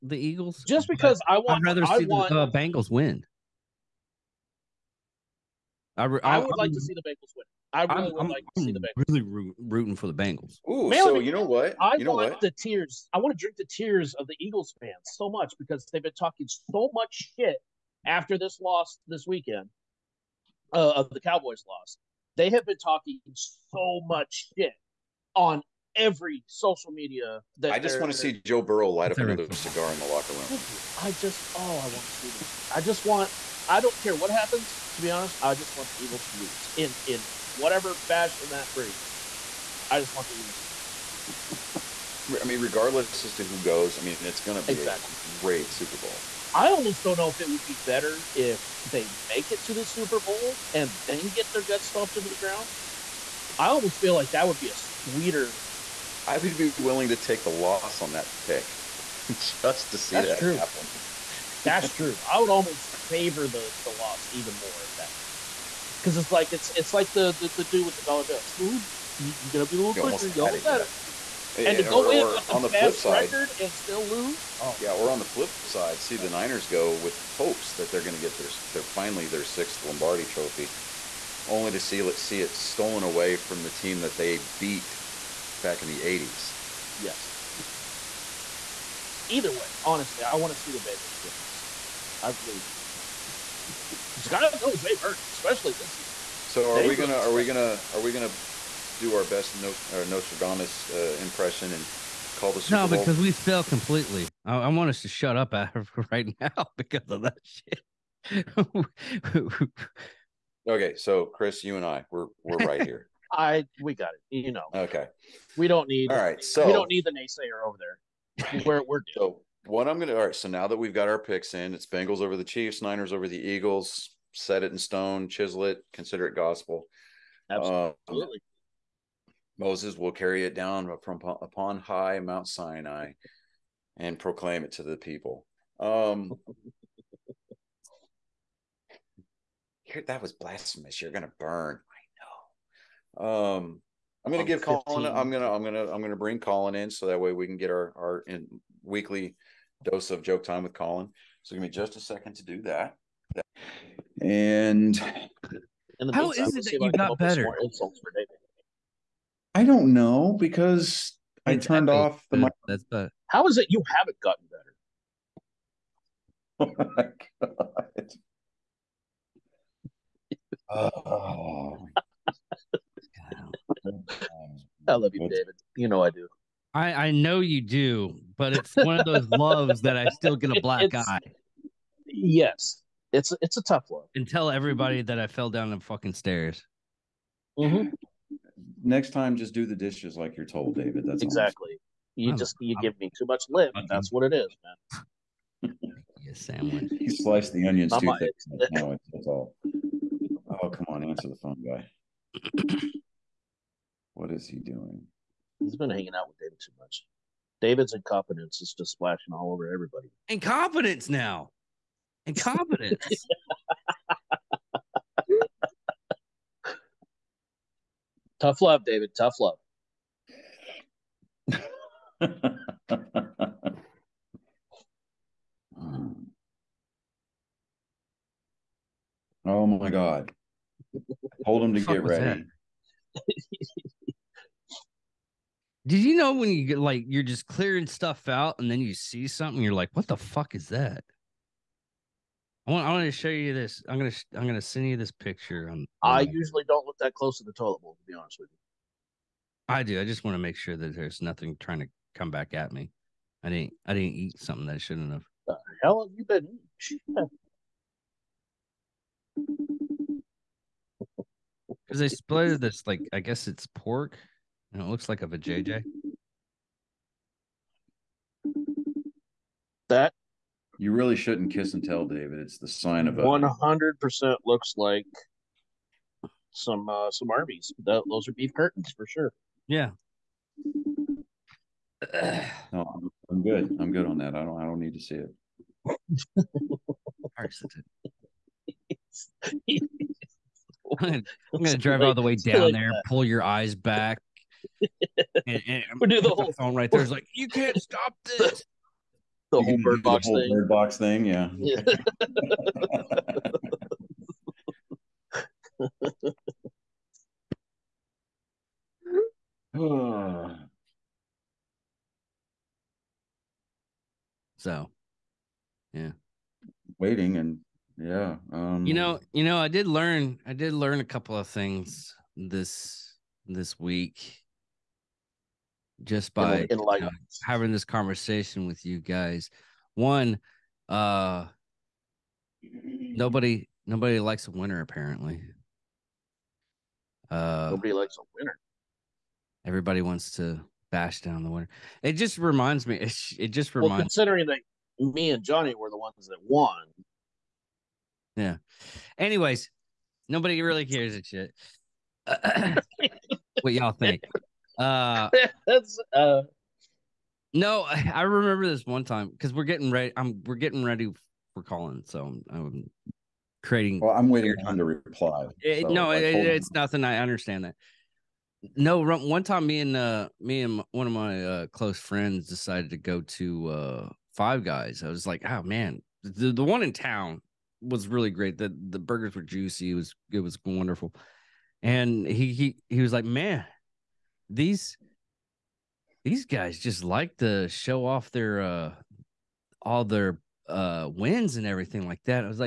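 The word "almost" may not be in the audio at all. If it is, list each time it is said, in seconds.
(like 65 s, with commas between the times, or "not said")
46 s, 53 s, 62 s.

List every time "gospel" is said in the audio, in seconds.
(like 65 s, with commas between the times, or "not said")
126 s.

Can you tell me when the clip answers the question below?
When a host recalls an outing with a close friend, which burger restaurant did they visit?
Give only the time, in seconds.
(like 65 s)
374 s.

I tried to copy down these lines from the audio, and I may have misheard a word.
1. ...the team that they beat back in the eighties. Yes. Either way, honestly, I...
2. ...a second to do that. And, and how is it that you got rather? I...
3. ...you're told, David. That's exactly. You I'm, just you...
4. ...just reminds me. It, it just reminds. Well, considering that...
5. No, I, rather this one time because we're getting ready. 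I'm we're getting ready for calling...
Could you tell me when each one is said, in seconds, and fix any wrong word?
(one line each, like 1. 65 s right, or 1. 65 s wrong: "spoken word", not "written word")
1. 83 s right
2. 151 s wrong: "better", not "rather"
3. 190 s right
4. 342 s right
5. 357 s wrong: "remember", not "rather".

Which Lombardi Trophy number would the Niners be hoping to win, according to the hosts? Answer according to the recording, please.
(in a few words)
6th.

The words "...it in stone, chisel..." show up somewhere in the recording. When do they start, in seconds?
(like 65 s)
124 s.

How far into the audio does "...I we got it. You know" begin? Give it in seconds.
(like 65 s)
113 s.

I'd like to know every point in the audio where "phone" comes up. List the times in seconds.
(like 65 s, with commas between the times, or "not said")
201 s, 296 s.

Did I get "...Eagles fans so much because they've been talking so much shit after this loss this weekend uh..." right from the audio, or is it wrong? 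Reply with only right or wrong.
right.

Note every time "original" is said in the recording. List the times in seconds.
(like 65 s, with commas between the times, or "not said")
not said.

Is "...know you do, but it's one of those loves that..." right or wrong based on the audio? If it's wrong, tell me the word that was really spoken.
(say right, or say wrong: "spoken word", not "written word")
right.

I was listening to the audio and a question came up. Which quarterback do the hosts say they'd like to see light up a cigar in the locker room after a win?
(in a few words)
Joe Burrow.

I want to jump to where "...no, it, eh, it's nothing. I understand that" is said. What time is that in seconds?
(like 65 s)
365 s.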